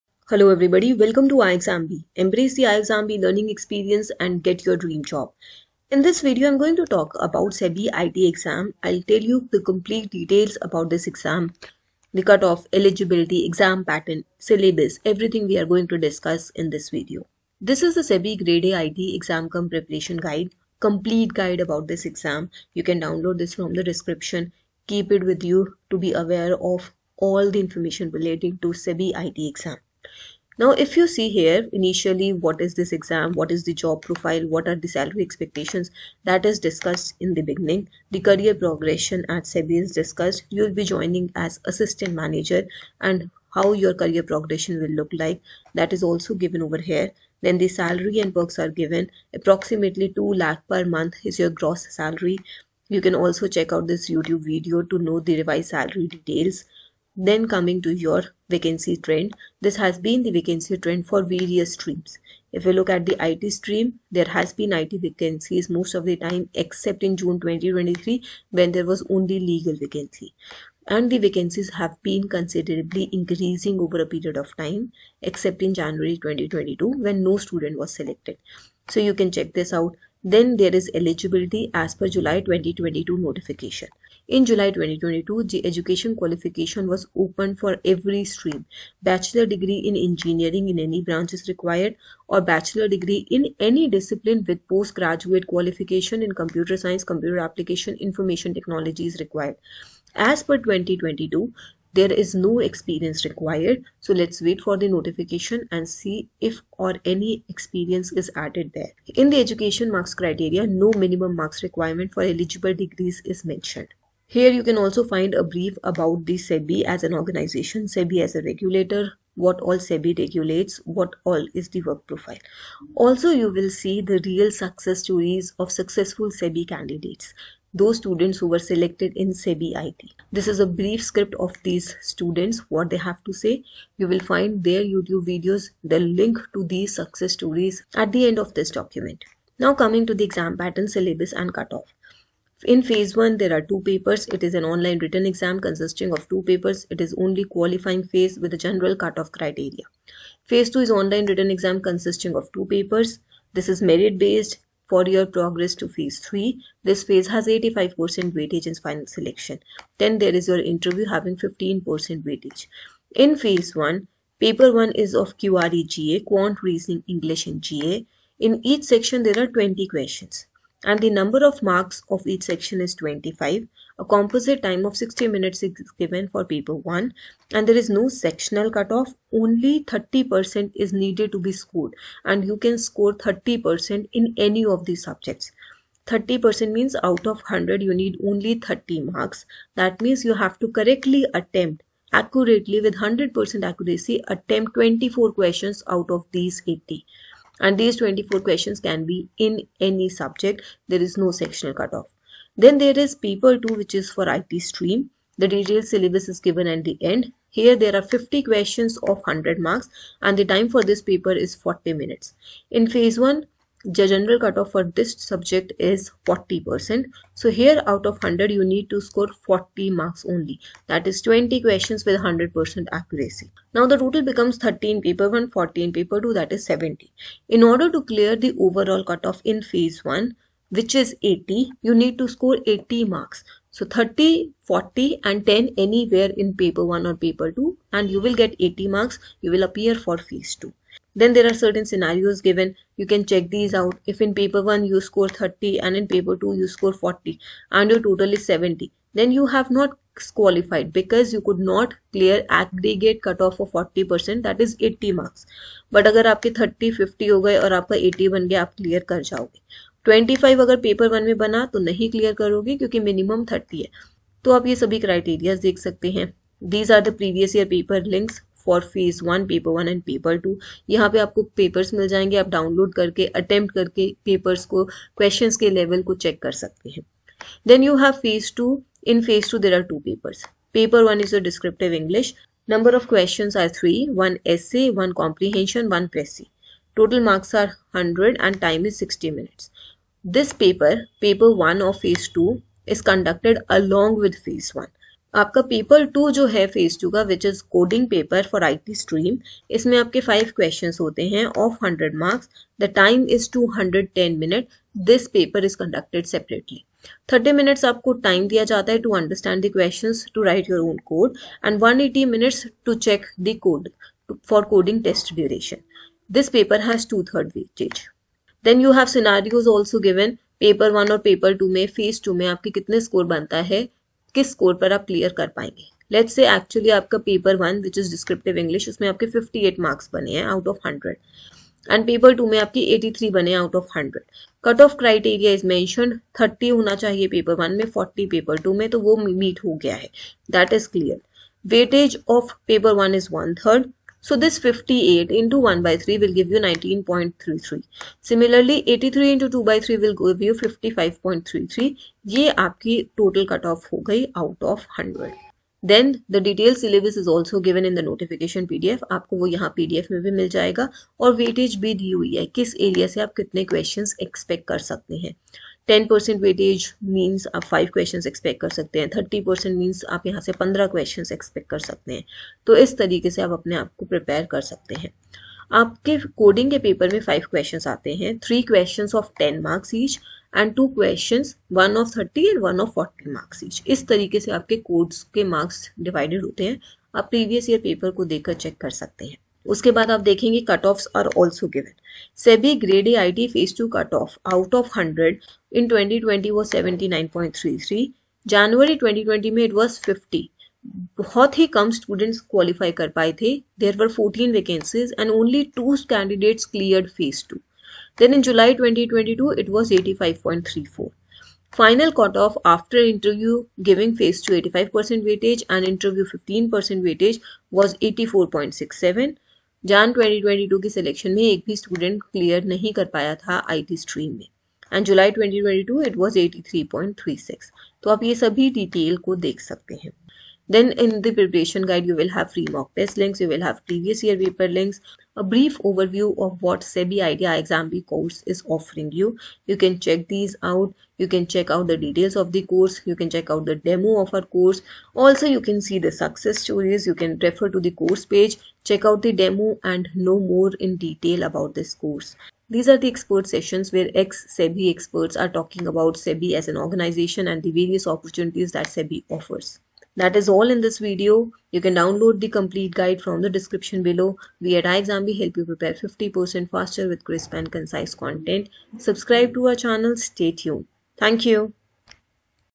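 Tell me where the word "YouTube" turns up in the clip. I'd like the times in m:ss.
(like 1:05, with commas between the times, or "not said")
0:54, 2:14.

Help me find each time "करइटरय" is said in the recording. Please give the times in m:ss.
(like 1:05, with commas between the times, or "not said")
5:34.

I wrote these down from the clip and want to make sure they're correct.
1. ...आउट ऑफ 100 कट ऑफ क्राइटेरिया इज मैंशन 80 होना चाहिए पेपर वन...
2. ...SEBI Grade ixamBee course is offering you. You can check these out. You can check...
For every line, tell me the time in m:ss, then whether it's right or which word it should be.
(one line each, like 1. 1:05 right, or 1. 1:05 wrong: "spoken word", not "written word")
1. 5:33 wrong: "30", not "80"
2. 7:16 wrong: "IDEA", not "Grade".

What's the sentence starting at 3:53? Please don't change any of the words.
So 30, 40 and 10 anywhere in paper 1 or paper 2 and you will get 80 marks.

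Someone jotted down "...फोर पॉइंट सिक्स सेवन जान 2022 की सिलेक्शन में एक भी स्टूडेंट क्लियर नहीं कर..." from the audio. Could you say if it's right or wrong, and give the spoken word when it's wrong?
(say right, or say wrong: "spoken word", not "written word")
right.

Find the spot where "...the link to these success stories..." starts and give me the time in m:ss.
2:15.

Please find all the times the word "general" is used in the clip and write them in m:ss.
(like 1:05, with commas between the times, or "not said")
2:28, 3:34.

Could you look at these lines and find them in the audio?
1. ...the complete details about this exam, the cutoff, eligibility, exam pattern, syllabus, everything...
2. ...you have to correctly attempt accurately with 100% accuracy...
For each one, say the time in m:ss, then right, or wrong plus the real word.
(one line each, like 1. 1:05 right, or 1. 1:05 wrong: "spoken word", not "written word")
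1. 0:09 right
2. 3:10 right.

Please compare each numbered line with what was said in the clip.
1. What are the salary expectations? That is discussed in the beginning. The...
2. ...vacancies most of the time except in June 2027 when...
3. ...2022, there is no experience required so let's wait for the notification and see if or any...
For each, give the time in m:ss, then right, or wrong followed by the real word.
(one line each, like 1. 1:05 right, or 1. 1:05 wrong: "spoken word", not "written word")
1. 0:34 right
2. 1:04 wrong: "2023", not "2027"
3. 1:40 right.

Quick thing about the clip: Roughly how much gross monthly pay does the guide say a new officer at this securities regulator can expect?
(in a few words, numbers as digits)
2 lakh.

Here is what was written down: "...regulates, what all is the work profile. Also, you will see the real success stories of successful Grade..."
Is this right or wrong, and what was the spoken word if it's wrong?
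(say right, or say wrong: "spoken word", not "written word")
wrong: "SEBI", not "Grade".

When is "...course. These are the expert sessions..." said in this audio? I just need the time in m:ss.
7:31.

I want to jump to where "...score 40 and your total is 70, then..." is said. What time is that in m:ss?
4:06.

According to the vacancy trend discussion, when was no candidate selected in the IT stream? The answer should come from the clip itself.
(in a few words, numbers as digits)
January 2022.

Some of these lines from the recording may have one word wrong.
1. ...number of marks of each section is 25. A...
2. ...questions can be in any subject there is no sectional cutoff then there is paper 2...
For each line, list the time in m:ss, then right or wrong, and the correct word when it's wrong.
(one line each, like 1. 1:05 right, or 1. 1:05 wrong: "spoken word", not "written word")
1. 2:51 right
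2. 3:18 right.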